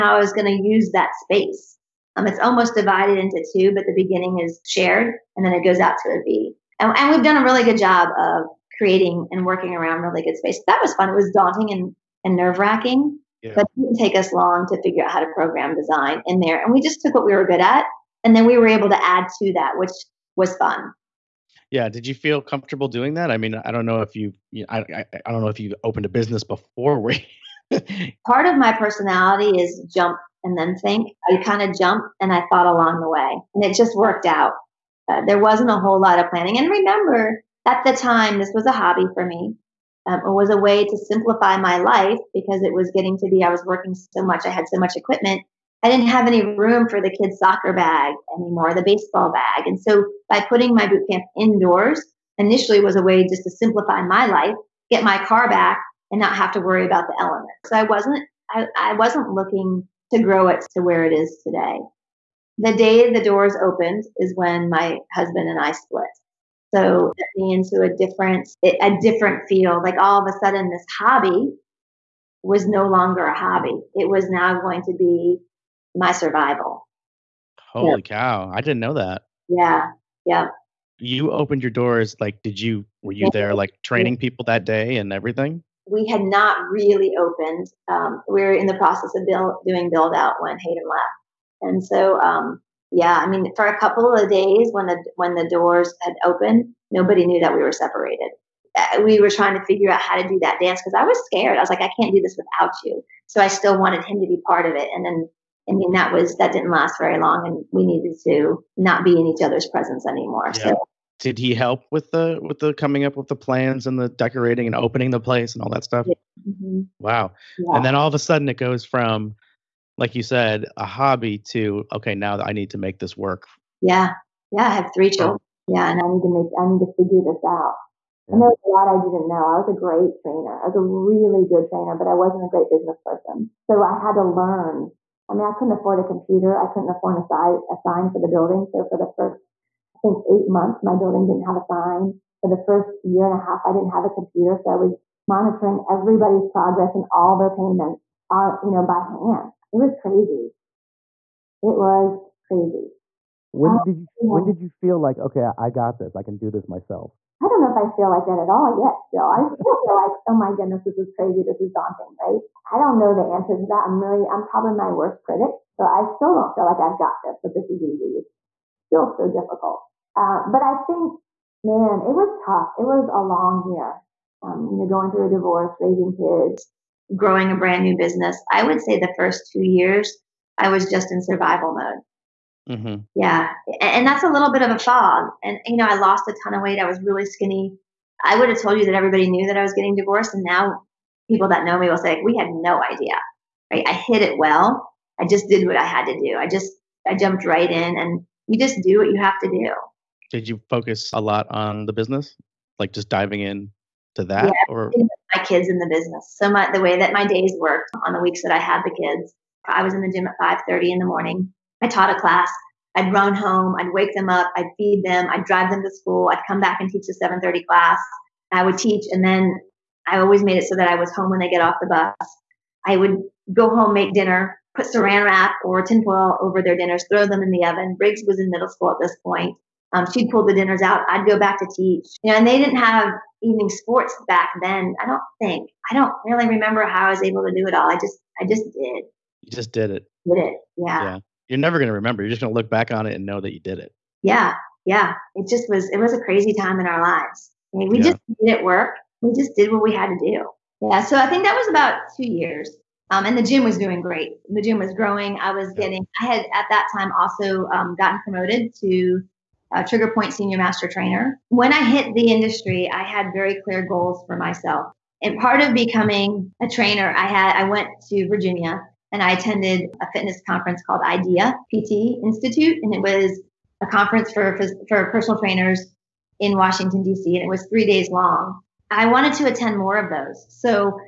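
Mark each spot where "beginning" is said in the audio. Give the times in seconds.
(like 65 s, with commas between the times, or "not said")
3 s.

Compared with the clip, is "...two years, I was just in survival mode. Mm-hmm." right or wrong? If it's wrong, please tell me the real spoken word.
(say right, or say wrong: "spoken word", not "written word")
right.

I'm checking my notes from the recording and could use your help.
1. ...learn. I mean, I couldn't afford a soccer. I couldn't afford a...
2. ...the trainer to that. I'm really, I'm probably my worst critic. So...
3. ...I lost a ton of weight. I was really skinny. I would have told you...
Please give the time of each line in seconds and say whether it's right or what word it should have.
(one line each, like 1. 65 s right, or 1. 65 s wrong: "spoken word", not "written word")
1. 134 s wrong: "computer", not "soccer"
2. 163 s wrong: "answer", not "trainer"
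3. 185 s right.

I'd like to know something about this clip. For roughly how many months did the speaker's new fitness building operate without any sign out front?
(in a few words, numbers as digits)
8 months.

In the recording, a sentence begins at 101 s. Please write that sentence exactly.
I was like, I can't do this without you.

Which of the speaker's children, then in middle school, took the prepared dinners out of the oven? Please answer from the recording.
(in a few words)
Briggs.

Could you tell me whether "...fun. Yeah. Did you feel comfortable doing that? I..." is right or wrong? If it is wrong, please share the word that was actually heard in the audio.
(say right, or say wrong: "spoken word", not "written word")
right.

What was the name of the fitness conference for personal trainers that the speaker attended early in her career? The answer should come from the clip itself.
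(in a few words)
IDEA PT Institute.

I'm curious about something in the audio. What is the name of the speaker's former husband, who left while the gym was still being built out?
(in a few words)
Hayden.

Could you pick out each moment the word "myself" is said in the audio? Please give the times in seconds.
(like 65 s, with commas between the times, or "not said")
156 s, 264 s.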